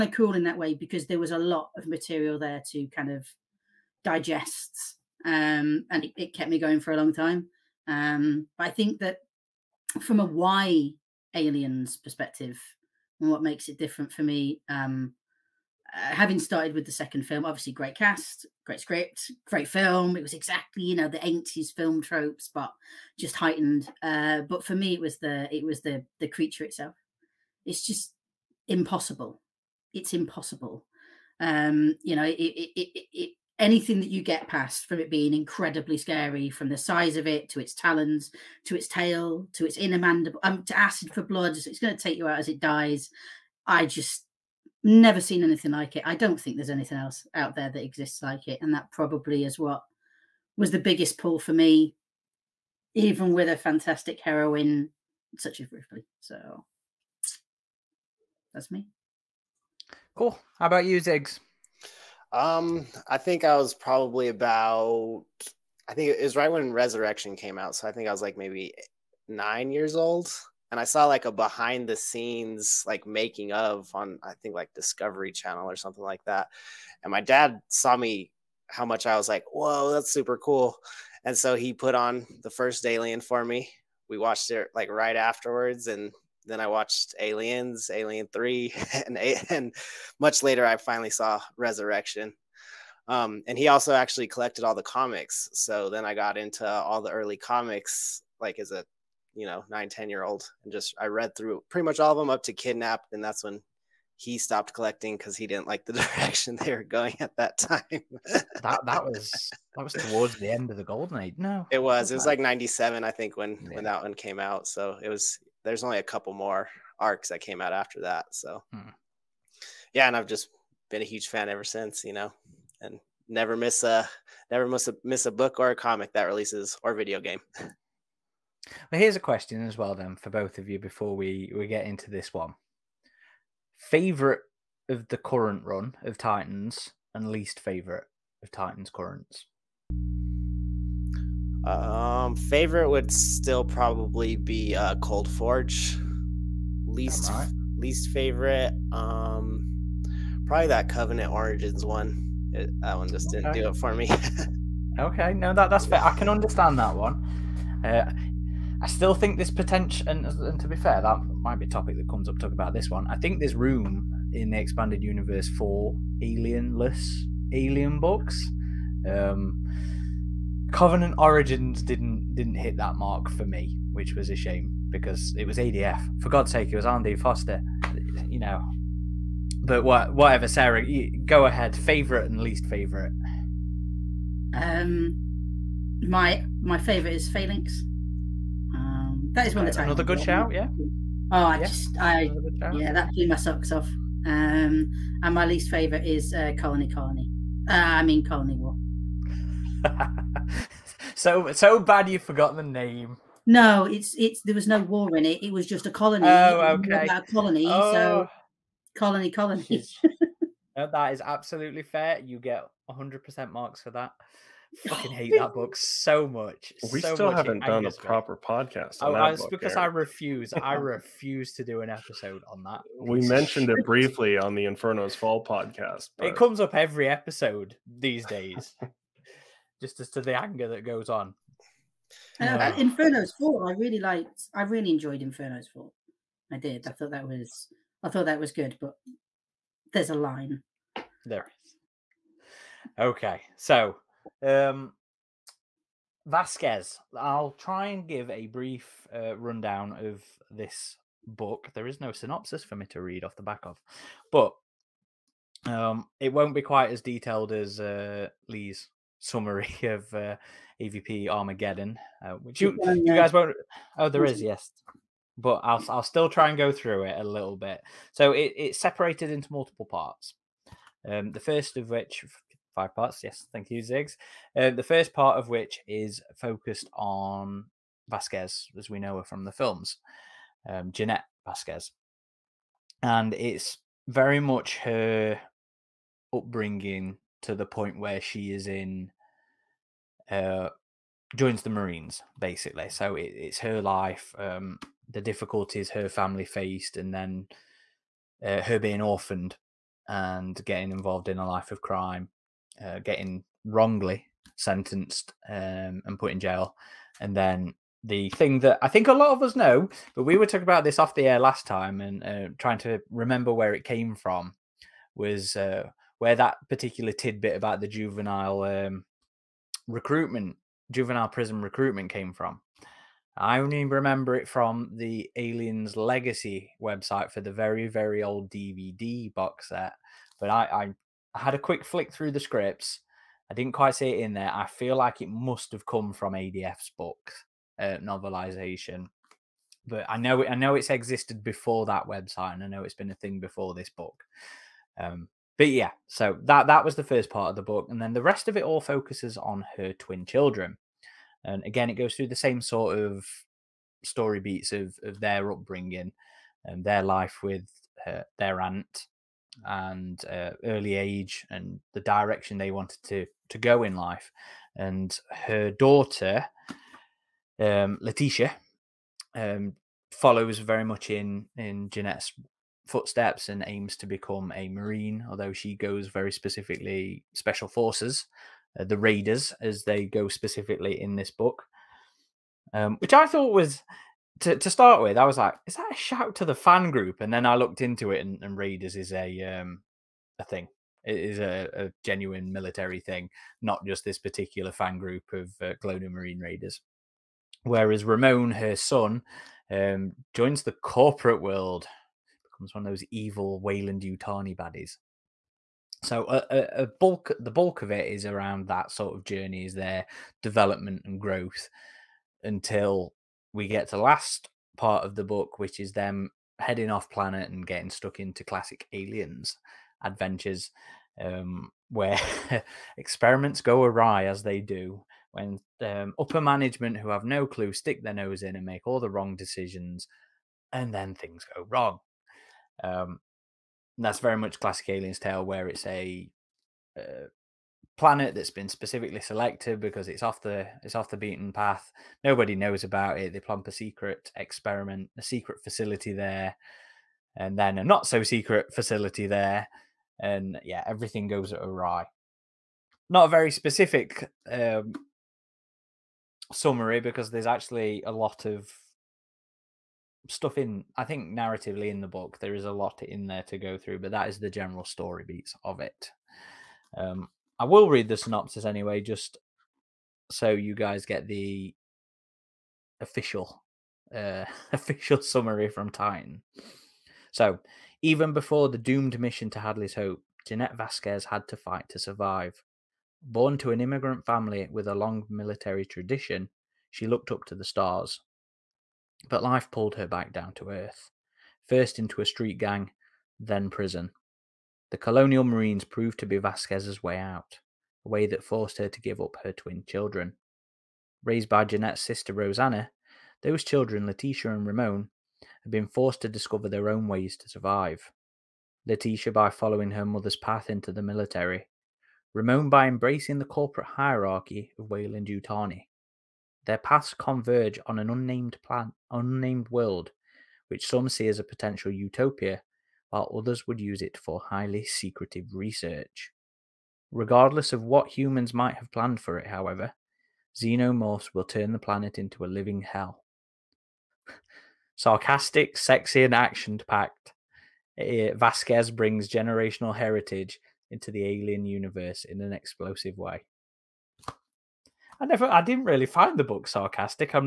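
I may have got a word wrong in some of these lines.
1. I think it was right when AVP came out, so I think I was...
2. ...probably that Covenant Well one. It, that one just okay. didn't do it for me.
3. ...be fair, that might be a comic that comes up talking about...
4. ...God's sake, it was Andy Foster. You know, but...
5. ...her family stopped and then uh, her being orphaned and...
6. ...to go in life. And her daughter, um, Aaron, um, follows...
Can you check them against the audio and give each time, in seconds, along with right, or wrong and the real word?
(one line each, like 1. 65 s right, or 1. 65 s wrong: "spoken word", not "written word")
1. 65 s wrong: "Resurrection", not "AVP"
2. 150 s wrong: "Origins", not "Well"
3. 160 s wrong: "topic", not "comic"
4. 176 s right
5. 295 s wrong: "faced", not "stopped"
6. 363 s wrong: "Letitia", not "Aaron".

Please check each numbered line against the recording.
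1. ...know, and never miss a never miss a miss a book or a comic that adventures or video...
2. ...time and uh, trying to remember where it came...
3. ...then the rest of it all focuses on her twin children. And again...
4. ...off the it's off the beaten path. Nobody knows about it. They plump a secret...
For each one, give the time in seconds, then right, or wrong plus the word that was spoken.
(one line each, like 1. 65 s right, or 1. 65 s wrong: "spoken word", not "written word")
1. 122 s wrong: "releases", not "adventures"
2. 311 s right
3. 347 s right
4. 440 s right.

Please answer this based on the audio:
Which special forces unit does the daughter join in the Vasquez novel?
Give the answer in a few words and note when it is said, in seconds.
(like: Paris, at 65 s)
The Raiders, at 378 s.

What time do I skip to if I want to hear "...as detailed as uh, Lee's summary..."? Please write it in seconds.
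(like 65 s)
256 s.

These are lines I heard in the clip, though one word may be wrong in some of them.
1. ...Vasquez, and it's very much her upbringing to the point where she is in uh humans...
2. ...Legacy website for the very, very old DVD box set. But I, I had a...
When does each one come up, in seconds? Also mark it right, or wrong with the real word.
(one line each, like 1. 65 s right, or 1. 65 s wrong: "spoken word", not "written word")
1. 281 s wrong: "joins", not "humans"
2. 325 s right.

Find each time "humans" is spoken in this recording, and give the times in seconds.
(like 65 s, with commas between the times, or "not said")
528 s.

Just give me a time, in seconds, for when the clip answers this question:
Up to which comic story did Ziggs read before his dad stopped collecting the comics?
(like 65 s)
102 s.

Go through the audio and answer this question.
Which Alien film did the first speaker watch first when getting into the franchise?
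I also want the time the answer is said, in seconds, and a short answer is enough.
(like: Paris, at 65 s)
The second film, at 16 s.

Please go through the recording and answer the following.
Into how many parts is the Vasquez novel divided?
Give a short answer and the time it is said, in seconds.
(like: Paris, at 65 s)
5, at 272 s.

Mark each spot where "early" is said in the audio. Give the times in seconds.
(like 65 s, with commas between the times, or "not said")
97 s, 360 s.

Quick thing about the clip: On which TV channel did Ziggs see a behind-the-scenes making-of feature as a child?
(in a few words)
Discovery Channel.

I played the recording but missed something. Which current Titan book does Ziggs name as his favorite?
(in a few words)
Cold Forge.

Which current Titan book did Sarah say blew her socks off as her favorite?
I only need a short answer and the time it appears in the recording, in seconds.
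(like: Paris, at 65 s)
Phalanx, at 187 s.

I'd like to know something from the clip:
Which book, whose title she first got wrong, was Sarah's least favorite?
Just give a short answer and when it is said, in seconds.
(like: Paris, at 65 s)
Colony War, at 198 s.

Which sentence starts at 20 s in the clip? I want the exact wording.
It was exactly you know the eighties film tropes, but just heightened.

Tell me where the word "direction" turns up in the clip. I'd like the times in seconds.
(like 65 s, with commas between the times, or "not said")
105 s, 362 s.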